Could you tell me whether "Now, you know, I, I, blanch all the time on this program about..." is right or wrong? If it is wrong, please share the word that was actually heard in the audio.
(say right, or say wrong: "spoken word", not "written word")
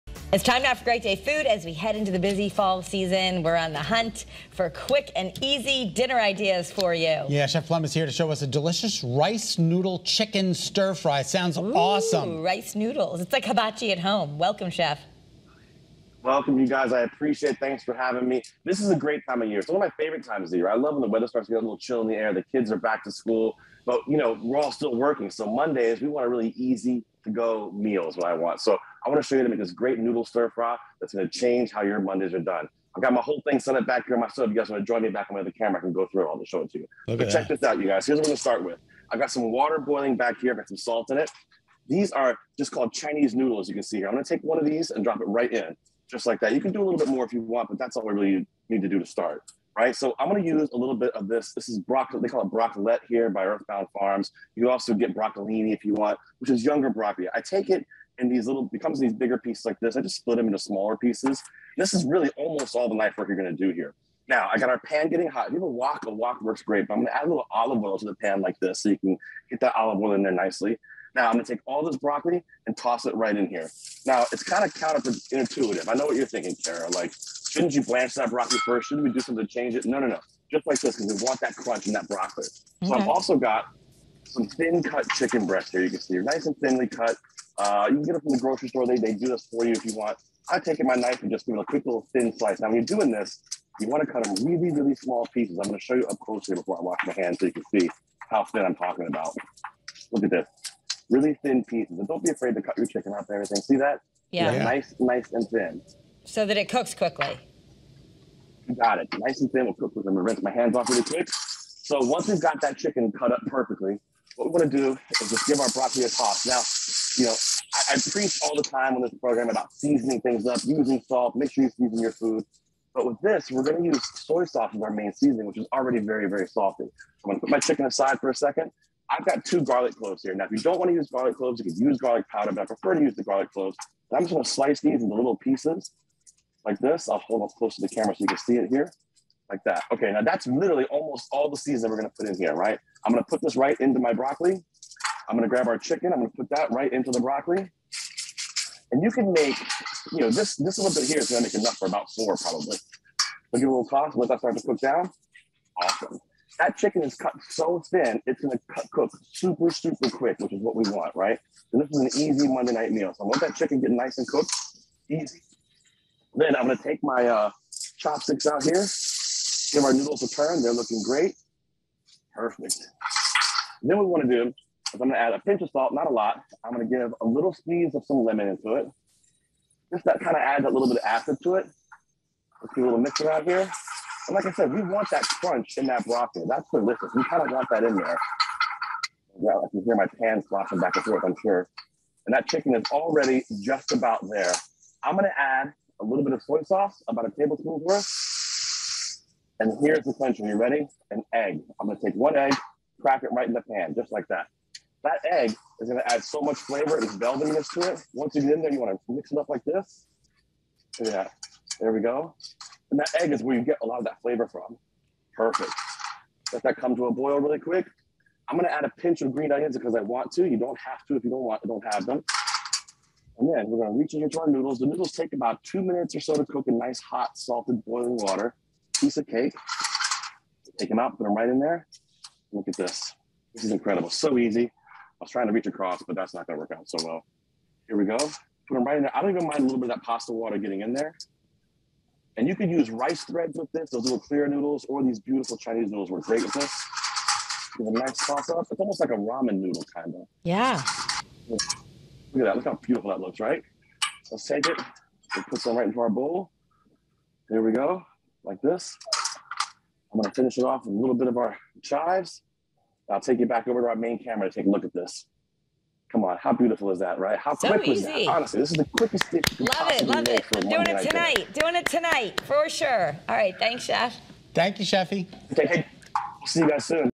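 wrong: "preach", not "blanch".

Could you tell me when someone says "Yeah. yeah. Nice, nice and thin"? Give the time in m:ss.
1:44.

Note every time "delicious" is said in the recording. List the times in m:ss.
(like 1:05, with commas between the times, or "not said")
0:08, 3:06.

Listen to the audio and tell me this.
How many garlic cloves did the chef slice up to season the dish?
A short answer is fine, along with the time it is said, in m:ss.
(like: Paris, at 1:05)
2, at 2:09.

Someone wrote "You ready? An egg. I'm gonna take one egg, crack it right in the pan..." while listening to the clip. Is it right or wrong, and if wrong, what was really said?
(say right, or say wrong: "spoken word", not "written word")
right.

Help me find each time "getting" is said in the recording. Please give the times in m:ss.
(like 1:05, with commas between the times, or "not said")
1:05, 4:00.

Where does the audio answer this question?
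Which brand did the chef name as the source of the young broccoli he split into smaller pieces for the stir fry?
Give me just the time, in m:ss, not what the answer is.
0:53.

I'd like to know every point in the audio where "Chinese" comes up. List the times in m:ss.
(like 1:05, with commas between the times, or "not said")
0:42, 4:05.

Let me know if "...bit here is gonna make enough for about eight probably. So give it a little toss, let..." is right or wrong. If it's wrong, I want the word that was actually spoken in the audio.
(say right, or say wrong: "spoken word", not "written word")
wrong: "four", not "eight".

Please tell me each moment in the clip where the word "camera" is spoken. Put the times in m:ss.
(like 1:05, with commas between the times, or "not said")
0:35, 2:17, 4:24.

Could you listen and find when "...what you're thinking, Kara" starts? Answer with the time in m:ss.
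1:16.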